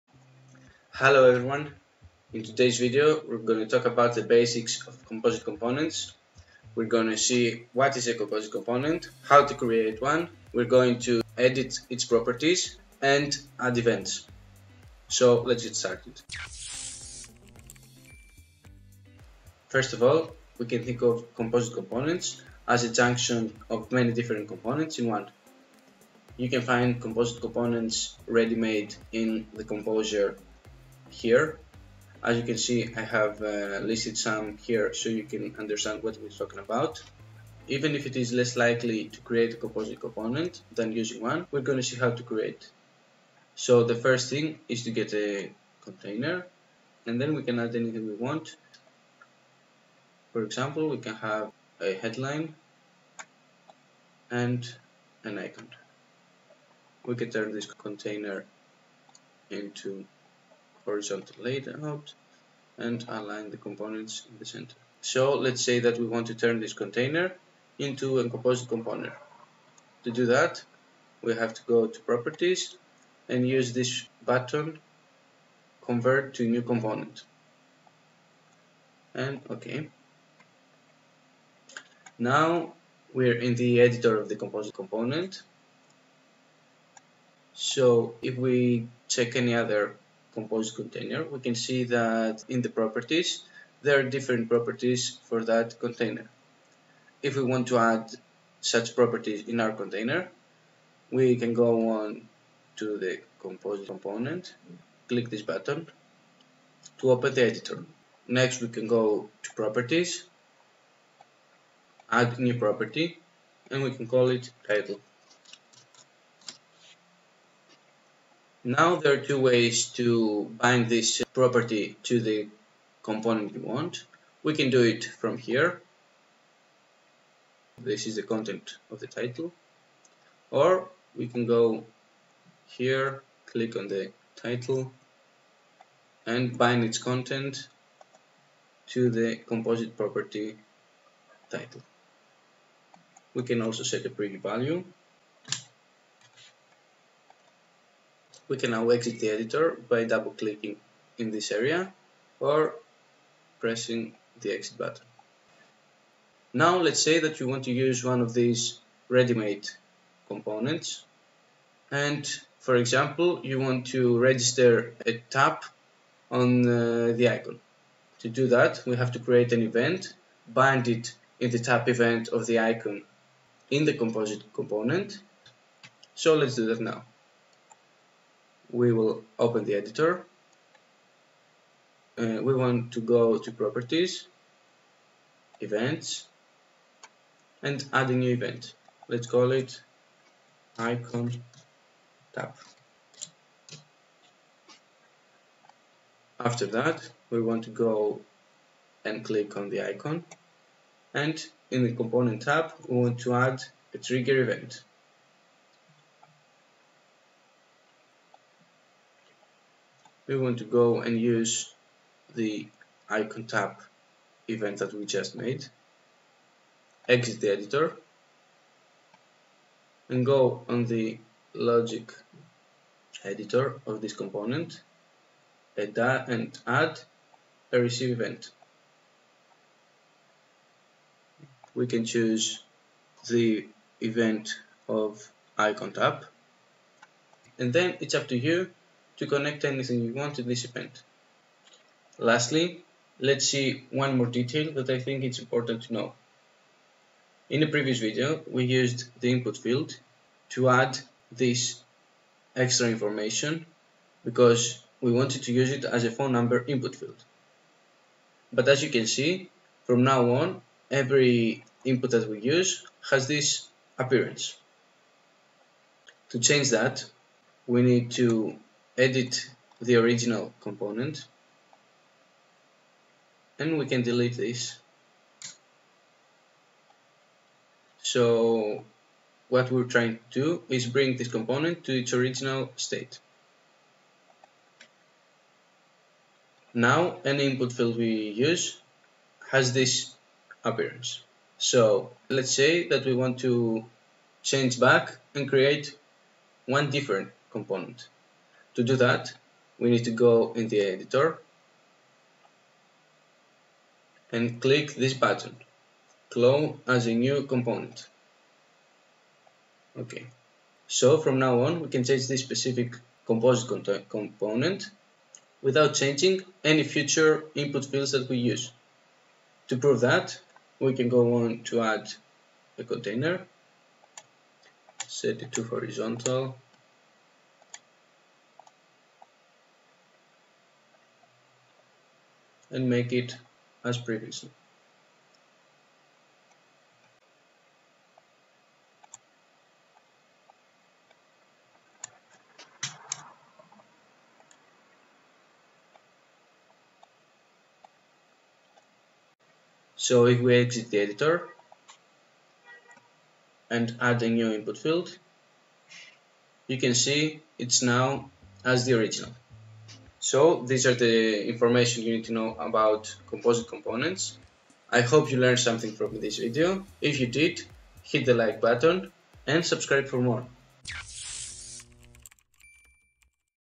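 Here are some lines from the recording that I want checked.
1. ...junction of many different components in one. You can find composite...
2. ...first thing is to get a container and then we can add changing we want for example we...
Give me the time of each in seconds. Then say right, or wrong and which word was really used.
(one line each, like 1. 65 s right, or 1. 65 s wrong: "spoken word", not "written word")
1. 22 s right
2. 43 s wrong: "anything", not "changing".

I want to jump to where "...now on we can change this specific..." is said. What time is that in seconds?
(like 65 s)
311 s.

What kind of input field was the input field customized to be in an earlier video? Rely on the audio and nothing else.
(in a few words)
phone number input field.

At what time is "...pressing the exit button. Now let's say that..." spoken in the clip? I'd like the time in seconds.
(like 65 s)
153 s.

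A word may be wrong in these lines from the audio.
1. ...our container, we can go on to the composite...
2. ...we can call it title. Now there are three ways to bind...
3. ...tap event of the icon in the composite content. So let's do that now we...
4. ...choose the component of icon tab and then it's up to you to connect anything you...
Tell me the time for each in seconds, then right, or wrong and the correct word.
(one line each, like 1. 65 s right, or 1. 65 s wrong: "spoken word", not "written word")
1. 99 s right
2. 113 s wrong: "two", not "three"
3. 171 s wrong: "component", not "content"
4. 232 s wrong: "event", not "component".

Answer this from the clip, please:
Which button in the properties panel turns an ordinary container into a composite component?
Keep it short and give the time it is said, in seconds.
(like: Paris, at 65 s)
Convert to new component, at 75 s.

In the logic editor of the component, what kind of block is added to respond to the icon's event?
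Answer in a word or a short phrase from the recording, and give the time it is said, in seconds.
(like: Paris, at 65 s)
receive event, at 227 s.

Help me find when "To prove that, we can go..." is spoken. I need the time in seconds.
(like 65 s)
319 s.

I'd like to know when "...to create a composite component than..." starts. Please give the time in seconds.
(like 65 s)
39 s.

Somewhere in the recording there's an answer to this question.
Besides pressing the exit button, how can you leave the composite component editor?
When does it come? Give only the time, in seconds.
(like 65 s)
150 s.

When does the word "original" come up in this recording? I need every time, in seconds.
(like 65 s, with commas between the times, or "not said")
269 s, 282 s, 358 s.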